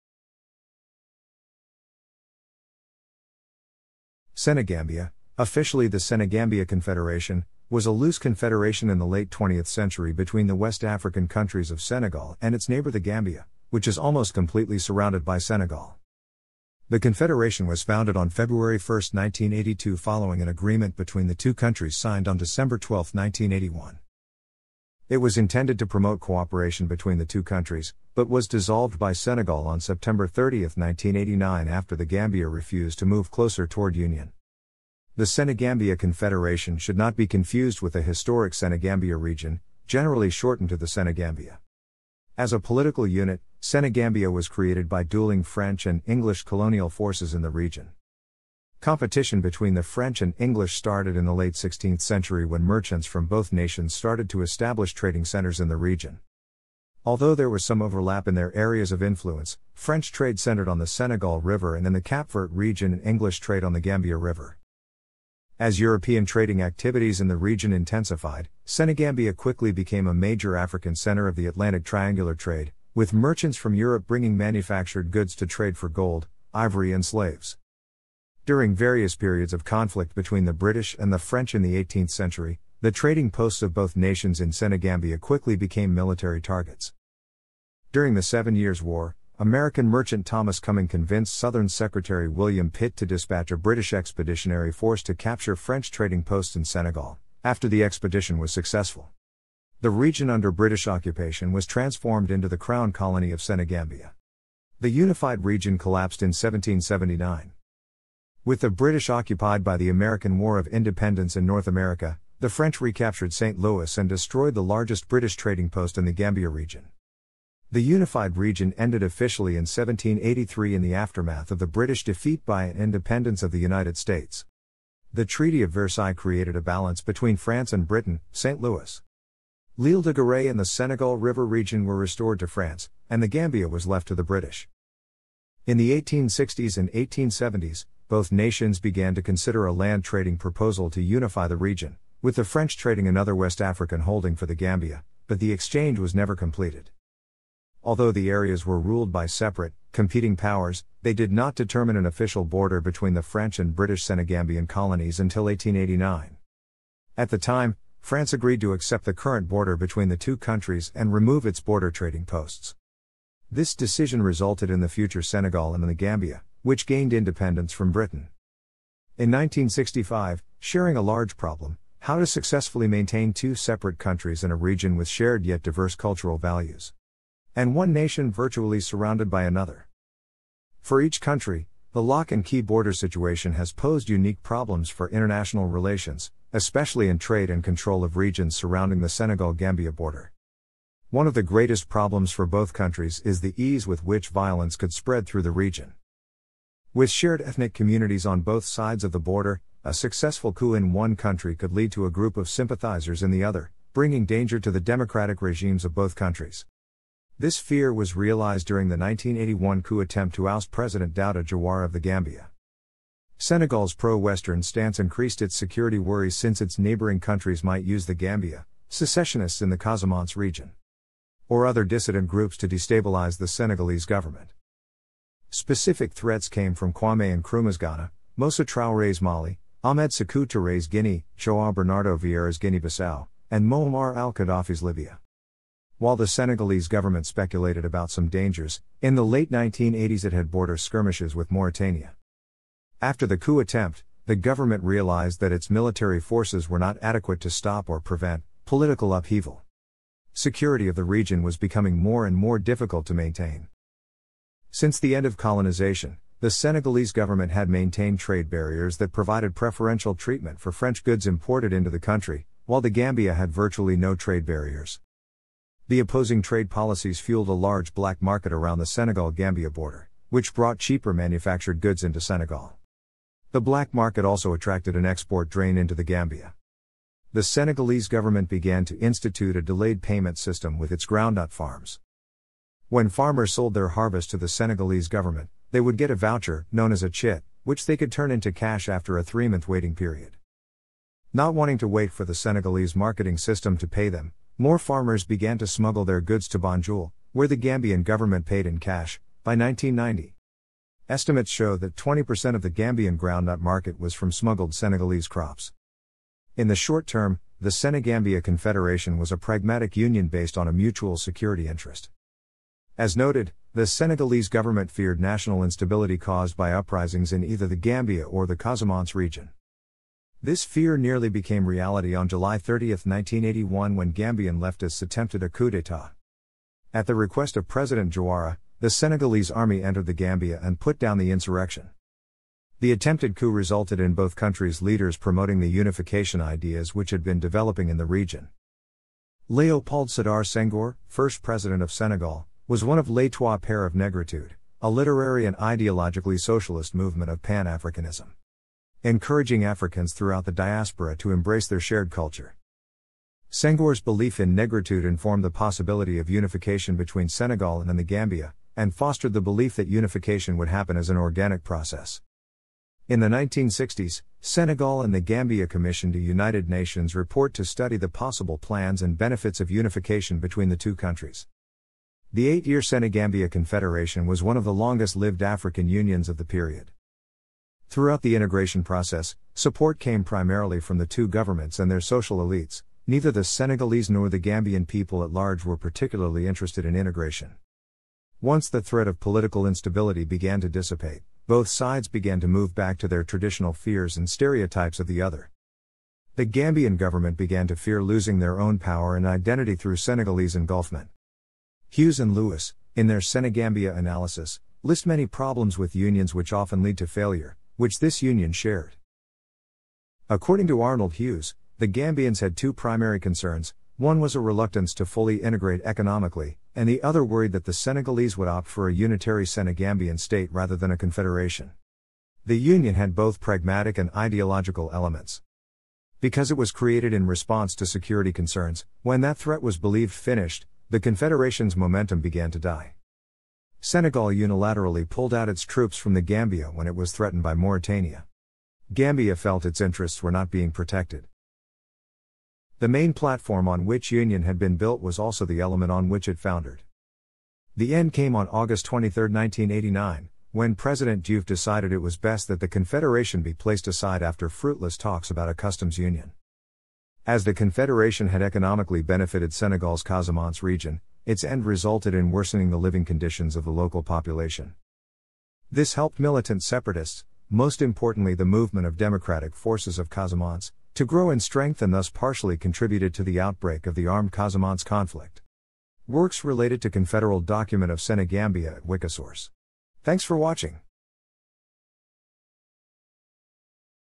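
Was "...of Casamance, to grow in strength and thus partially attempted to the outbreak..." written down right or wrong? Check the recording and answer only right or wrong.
wrong.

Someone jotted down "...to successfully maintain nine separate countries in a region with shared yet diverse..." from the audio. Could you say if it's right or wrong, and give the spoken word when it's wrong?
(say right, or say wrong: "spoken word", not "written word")
wrong: "two", not "nine".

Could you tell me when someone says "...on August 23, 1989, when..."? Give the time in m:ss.
7:28.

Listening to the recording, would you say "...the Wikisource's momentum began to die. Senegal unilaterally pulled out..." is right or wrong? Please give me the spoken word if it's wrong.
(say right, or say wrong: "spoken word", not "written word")
wrong: "Confederation", not "Wikisource".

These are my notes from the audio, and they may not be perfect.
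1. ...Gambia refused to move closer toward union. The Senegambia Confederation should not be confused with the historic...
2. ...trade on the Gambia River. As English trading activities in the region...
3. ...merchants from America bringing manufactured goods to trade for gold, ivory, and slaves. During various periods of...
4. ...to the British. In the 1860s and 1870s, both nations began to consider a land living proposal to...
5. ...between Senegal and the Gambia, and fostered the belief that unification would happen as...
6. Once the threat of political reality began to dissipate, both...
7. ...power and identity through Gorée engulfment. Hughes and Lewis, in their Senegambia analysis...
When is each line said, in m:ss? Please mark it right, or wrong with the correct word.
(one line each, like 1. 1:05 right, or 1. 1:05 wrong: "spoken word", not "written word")
1. 0:32 right
2. 1:03 wrong: "European", not "English"
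3. 1:13 wrong: "Europe", not "America"
4. 2:14 wrong: "trading", not "living"
5. 5:56 right
6. 6:28 wrong: "instability", not "reality"
7. 6:38 wrong: "Senegalese", not "Gorée".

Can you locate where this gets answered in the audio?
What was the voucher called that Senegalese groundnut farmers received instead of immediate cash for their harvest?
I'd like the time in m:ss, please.
4:47.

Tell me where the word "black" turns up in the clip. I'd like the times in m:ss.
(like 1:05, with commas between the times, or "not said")
4:27, 4:33.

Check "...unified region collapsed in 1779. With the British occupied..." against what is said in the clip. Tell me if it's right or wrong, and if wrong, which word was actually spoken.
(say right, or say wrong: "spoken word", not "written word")
right.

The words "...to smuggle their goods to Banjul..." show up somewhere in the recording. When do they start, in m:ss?
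4:55.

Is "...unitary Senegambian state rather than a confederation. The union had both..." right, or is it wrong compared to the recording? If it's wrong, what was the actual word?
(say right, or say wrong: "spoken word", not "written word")
right.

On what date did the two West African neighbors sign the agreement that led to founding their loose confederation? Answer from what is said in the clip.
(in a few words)
December 12, 1981.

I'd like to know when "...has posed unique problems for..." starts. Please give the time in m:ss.
3:03.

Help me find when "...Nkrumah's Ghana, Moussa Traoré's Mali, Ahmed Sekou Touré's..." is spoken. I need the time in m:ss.
3:47.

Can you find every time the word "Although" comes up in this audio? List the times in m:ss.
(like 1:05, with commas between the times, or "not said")
0:57, 2:27.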